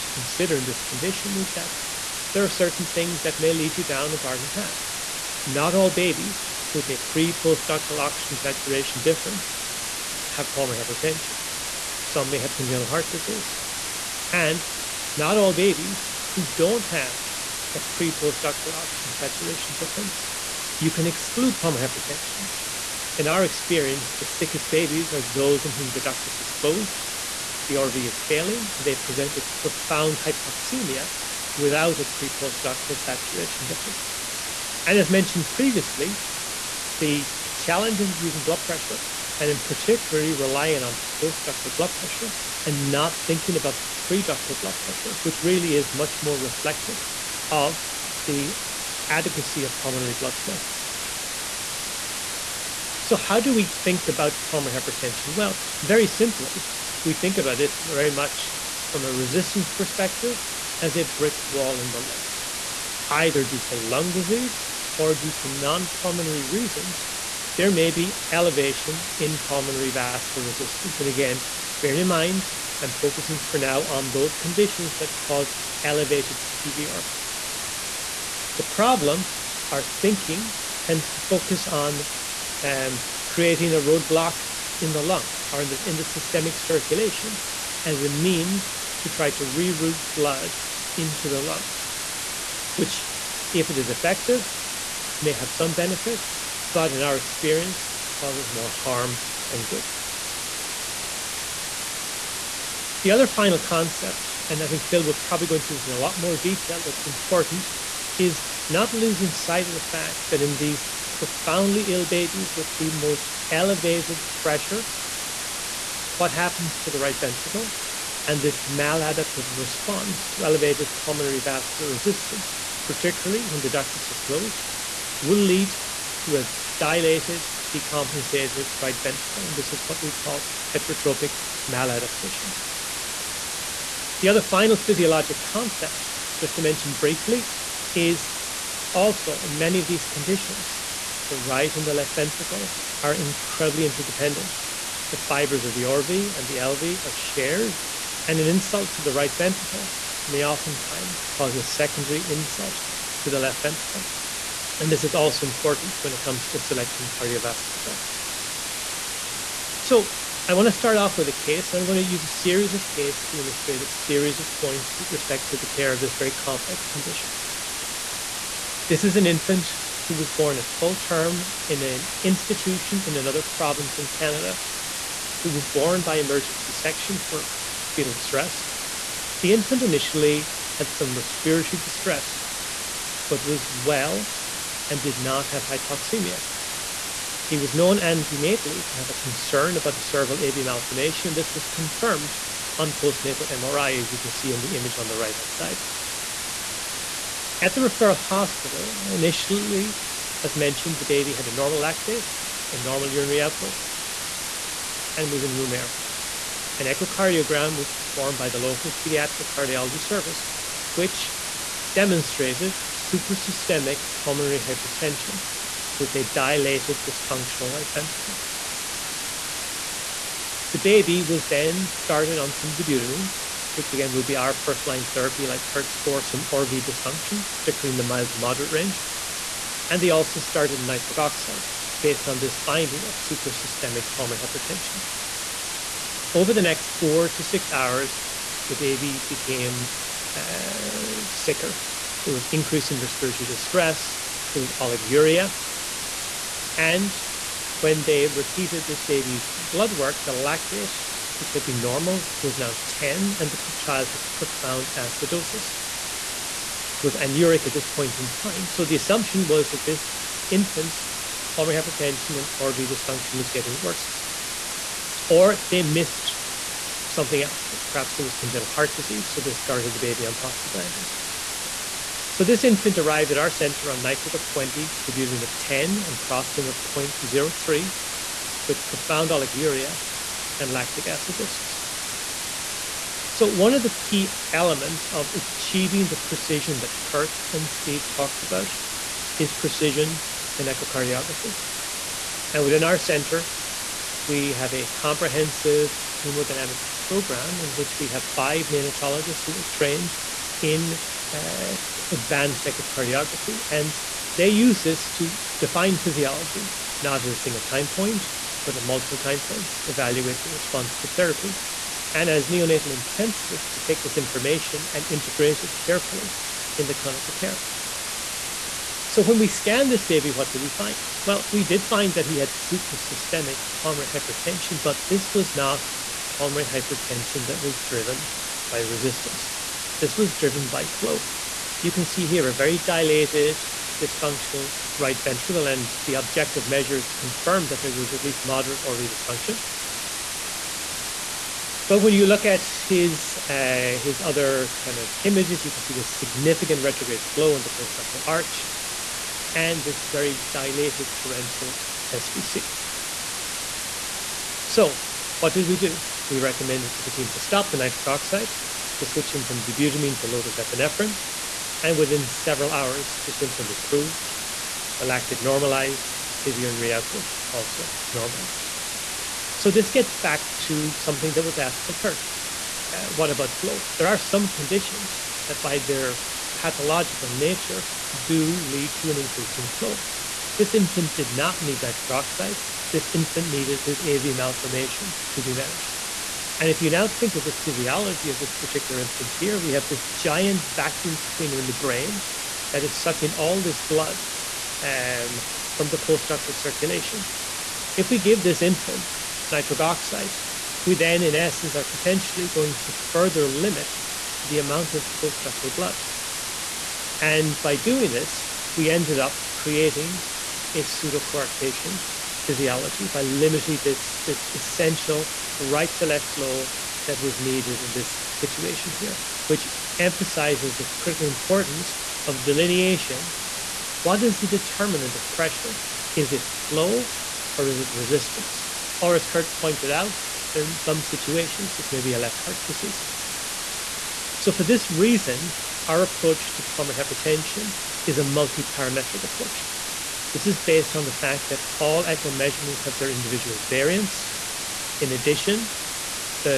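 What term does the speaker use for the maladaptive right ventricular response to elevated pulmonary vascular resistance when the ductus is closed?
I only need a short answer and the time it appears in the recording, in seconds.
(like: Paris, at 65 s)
heterotropic maladaptation, at 130 s.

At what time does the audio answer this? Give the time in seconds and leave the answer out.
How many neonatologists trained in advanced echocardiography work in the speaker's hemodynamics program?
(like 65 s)
298 s.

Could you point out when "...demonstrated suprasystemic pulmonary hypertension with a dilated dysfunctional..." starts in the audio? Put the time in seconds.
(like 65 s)
211 s.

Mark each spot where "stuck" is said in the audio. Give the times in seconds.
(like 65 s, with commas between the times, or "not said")
not said.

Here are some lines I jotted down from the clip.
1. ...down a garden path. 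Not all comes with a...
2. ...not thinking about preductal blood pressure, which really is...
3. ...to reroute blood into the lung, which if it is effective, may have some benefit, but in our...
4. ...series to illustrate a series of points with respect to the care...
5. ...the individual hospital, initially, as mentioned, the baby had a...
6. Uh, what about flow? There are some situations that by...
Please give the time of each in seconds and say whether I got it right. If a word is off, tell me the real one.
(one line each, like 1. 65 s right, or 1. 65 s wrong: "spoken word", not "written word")
1. 3 s wrong: "babies", not "comes"
2. 42 s right
3. 89 s right
4. 162 s wrong: "cases", not "series"
5. 197 s wrong: "referral", not "individual"
6. 372 s wrong: "conditions", not "situations".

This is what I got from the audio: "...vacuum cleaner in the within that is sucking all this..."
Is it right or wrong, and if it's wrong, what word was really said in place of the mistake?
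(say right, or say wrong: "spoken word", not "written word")
wrong: "brain", not "within".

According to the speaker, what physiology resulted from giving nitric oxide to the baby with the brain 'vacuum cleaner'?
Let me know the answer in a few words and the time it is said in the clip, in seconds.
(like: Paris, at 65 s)
pseudocoarctation physiology, at 410 s.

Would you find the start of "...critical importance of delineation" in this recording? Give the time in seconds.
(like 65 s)
420 s.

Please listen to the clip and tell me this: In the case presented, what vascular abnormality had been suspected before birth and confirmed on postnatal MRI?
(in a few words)
cervical AV malformation.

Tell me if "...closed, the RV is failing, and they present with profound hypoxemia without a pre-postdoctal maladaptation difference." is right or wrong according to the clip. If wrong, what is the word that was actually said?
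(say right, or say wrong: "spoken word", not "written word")
wrong: "saturation", not "maladaptation".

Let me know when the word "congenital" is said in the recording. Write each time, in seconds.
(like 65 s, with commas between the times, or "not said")
12 s, 268 s.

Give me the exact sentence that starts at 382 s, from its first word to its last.
This infant needed his AV malformation to be managed.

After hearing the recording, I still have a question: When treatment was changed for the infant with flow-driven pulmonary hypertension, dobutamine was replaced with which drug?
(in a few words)
low-dose epinephrine.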